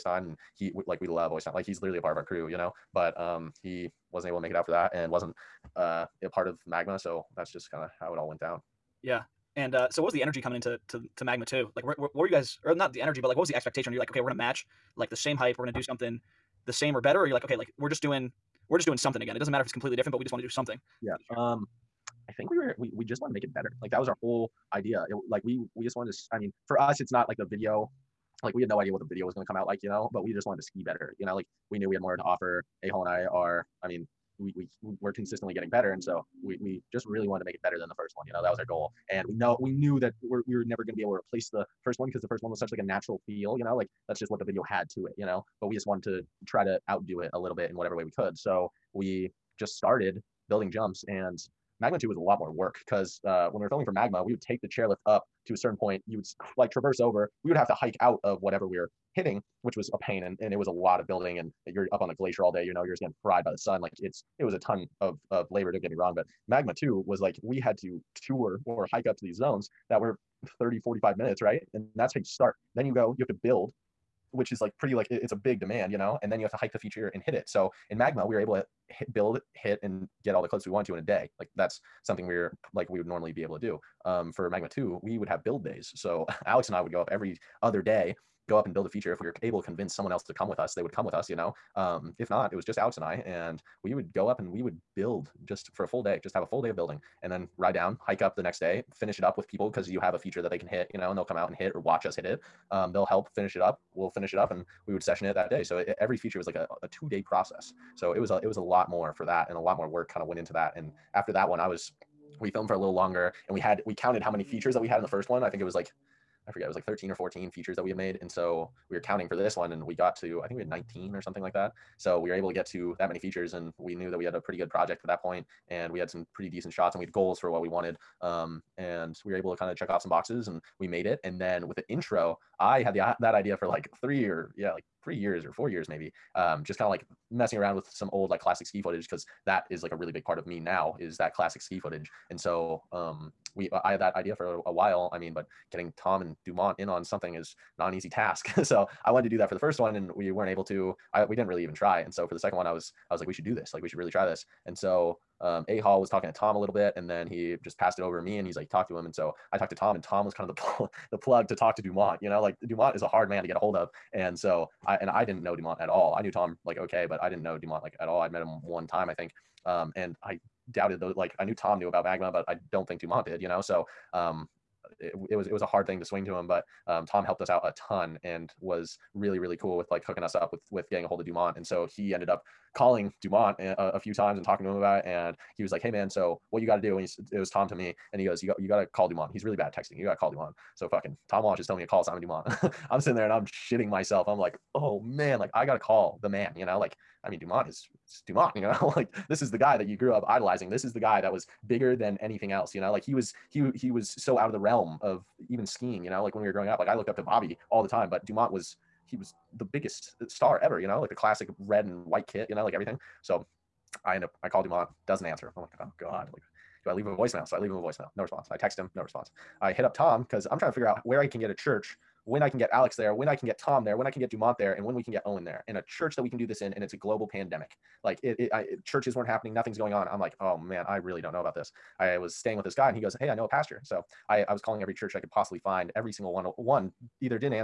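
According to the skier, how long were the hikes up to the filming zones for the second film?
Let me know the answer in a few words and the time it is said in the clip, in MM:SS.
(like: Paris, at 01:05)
30 to 45 minutes, at 01:10.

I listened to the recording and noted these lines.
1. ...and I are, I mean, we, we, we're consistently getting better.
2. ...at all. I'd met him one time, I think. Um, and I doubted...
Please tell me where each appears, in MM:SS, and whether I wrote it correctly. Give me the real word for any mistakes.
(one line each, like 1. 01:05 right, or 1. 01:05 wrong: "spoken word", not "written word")
1. 00:33 right
2. 02:47 right.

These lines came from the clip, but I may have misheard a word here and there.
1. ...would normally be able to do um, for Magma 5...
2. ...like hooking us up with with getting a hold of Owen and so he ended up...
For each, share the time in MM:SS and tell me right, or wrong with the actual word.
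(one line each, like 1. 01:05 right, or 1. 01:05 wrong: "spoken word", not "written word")
1. 01:22 wrong: "2", not "5"
2. 02:59 wrong: "Dumont", not "Owen".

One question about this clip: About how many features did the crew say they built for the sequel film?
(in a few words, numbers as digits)
19.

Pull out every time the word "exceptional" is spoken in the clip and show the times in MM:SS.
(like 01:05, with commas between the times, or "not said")
not said.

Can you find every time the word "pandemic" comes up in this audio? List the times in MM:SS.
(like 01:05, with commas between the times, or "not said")
03:47.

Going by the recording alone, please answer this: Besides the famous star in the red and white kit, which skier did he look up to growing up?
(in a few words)
Bobby.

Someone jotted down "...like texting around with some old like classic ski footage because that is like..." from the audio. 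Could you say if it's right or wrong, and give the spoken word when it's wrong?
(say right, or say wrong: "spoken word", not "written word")
wrong: "messing", not "texting".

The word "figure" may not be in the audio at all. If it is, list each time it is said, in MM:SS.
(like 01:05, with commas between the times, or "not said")
03:40.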